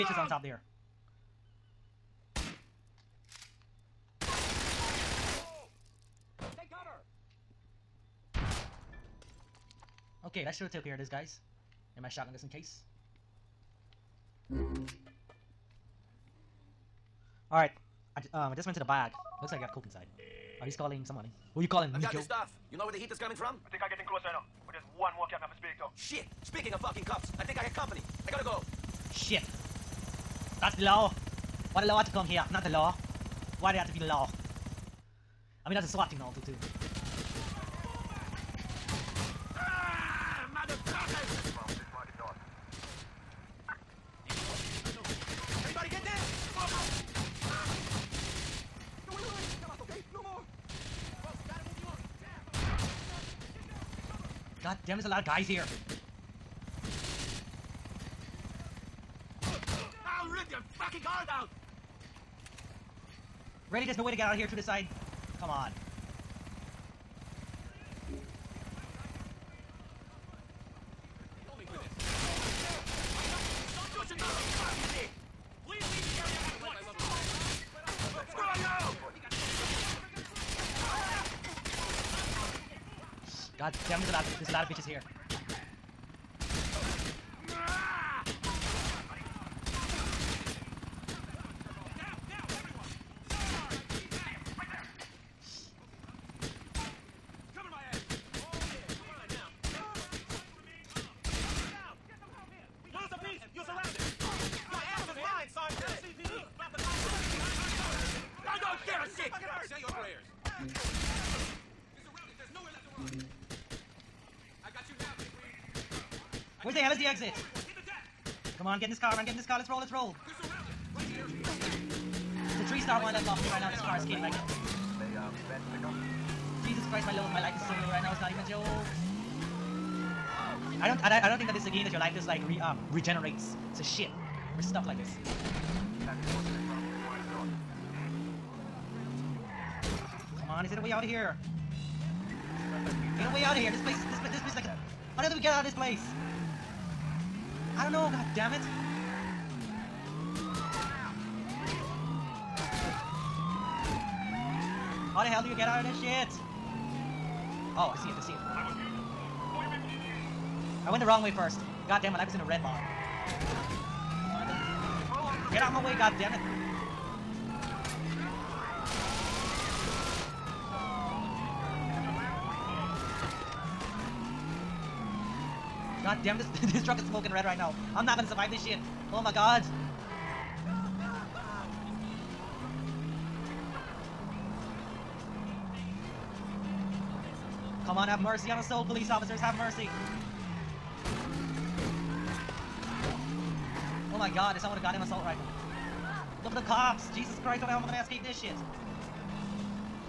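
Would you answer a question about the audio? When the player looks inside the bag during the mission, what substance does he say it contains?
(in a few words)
Coke.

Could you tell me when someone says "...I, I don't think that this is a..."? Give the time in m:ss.
2:11.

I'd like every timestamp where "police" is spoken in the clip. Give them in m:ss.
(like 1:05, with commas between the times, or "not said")
3:08.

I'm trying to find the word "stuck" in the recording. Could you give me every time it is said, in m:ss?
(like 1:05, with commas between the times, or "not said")
2:14.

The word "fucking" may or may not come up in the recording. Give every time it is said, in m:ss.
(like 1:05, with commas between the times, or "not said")
0:26, 1:00.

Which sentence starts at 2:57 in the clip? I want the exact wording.
I'm not gonna survive this shit.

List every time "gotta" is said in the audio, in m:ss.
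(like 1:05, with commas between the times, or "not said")
0:28.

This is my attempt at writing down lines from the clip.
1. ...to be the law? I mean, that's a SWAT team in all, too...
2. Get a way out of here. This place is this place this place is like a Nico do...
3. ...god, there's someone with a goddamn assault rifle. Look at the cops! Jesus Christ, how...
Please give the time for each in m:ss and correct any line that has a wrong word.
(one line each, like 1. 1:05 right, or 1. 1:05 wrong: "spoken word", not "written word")
1. 0:33 right
2. 2:23 wrong: "How", not "Nico"
3. 3:14 right.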